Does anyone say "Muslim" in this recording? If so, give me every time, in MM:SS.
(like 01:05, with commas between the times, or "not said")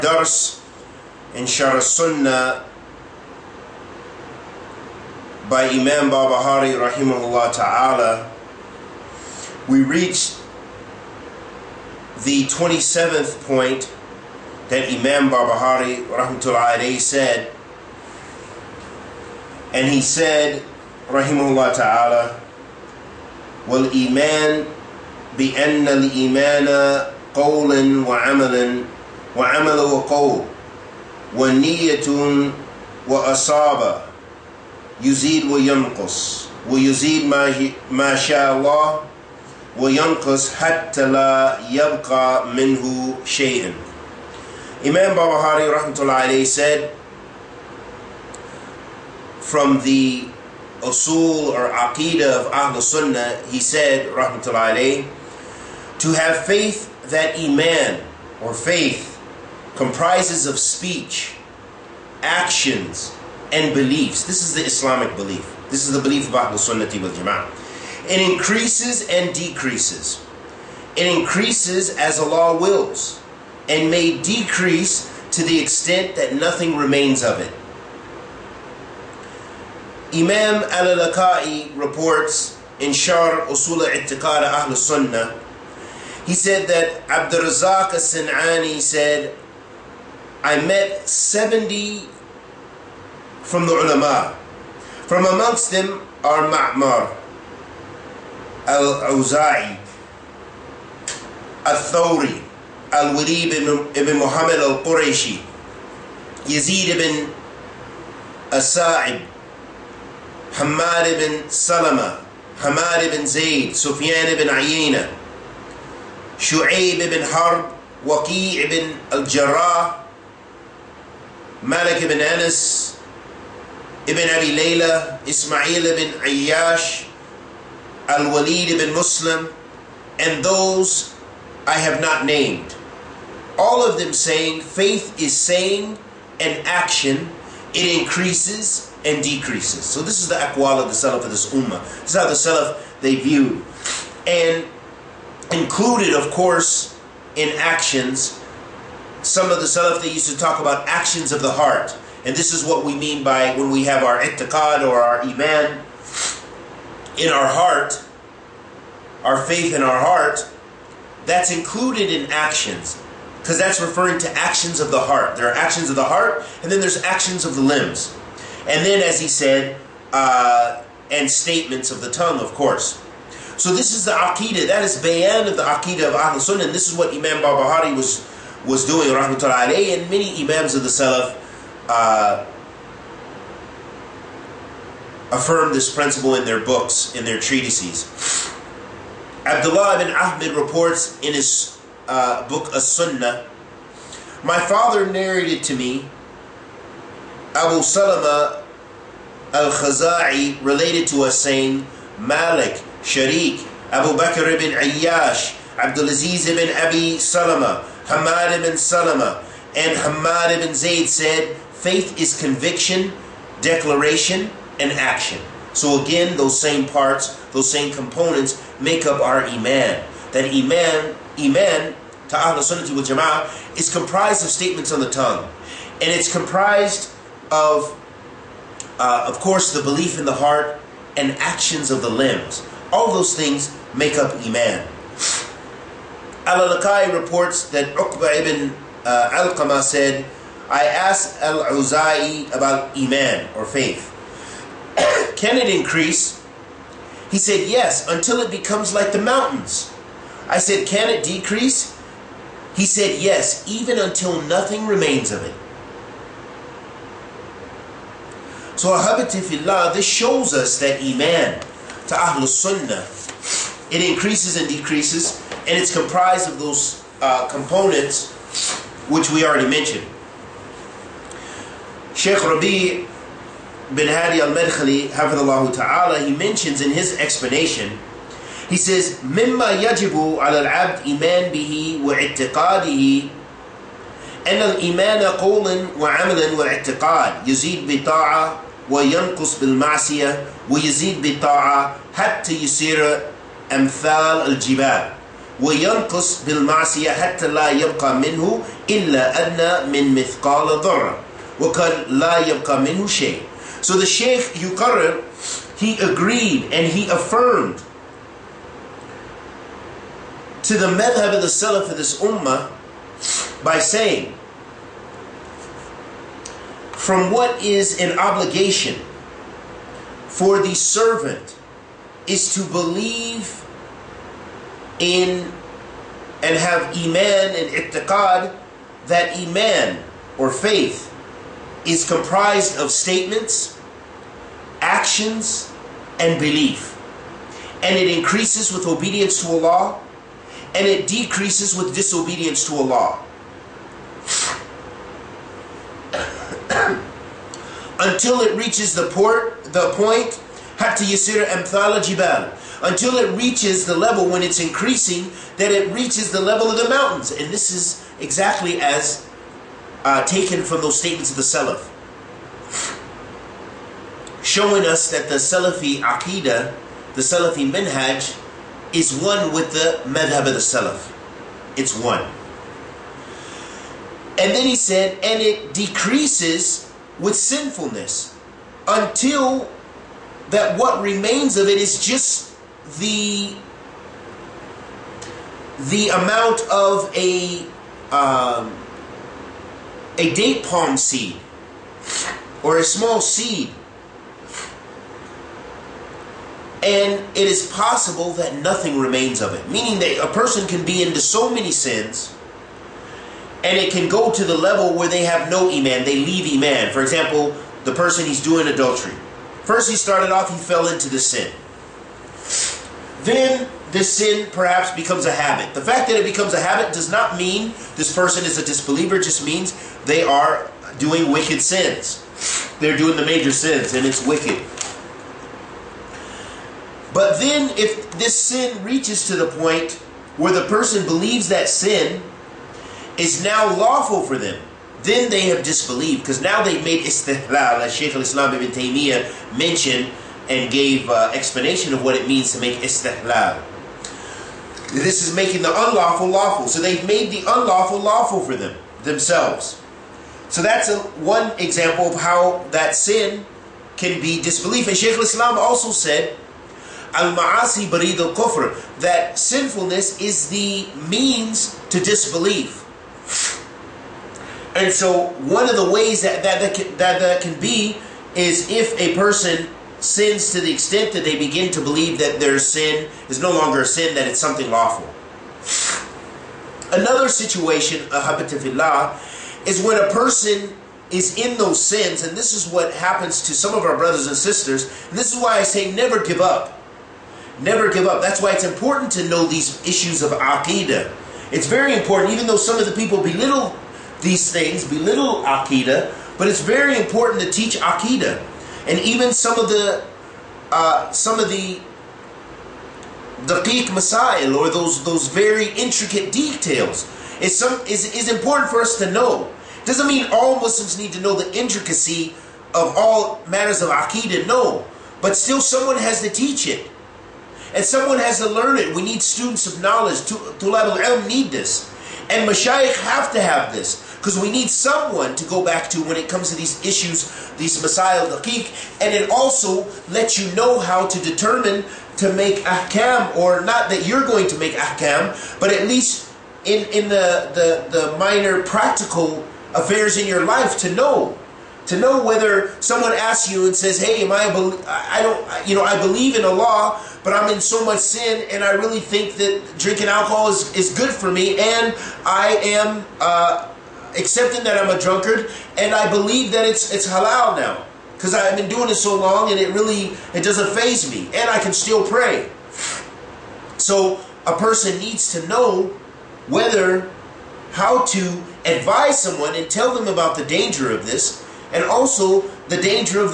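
02:08, 08:30.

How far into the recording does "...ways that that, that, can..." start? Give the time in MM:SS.
07:45.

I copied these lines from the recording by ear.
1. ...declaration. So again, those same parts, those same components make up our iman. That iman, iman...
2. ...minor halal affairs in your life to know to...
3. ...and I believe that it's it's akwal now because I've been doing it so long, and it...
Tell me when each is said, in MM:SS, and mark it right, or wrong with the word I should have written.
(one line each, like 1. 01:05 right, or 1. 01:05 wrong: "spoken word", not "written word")
1. 03:34 wrong: "action", not "declaration"
2. 08:58 wrong: "practical", not "halal"
3. 09:15 wrong: "halal", not "akwal".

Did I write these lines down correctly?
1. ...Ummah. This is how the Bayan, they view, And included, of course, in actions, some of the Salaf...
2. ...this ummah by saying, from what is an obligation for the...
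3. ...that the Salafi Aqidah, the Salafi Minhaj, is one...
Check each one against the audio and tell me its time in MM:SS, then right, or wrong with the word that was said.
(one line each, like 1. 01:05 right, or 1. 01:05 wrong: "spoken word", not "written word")
1. 02:21 wrong: "Salaf", not "Bayan"
2. 05:11 right
3. 06:05 right.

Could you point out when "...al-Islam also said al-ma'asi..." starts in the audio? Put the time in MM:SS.
07:35.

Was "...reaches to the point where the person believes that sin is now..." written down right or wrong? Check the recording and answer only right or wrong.
right.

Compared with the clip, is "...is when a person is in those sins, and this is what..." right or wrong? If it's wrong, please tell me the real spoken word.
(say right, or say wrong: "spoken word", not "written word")
right.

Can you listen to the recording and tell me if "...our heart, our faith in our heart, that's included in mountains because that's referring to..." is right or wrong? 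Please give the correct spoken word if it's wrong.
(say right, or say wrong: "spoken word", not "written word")
wrong: "actions", not "mountains".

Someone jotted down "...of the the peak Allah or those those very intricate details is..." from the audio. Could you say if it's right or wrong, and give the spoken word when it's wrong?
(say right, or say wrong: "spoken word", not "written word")
wrong: "Masail", not "Allah".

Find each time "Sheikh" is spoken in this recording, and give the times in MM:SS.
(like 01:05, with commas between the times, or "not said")
04:32, 05:04.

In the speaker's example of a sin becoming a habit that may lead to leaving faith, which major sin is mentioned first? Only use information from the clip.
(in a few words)
adultery.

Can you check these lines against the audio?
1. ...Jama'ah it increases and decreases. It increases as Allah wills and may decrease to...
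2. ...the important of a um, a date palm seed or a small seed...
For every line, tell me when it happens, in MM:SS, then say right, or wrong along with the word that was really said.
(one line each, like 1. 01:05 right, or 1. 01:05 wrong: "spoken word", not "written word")
1. 01:07 right
2. 06:25 wrong: "amount", not "important".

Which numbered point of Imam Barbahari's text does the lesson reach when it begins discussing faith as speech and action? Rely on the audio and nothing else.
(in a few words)
27th.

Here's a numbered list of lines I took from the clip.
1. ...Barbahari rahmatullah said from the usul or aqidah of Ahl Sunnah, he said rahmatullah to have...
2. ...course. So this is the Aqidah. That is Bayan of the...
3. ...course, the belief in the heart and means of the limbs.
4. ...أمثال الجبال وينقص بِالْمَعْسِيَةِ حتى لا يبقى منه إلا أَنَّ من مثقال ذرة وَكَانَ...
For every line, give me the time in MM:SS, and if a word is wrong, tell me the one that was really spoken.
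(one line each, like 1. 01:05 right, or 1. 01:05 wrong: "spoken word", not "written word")
1. 00:45 right
2. 02:52 right
3. 03:49 wrong: "actions", not "means"
4. 04:53 right.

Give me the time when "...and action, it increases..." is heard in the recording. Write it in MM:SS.
02:16.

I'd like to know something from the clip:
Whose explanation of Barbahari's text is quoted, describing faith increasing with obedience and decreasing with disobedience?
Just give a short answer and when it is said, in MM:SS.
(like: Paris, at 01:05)
Rabi bin Hadi al-Medkhali, at 04:32.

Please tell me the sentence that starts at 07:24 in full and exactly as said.
This is making the unlawful lawful.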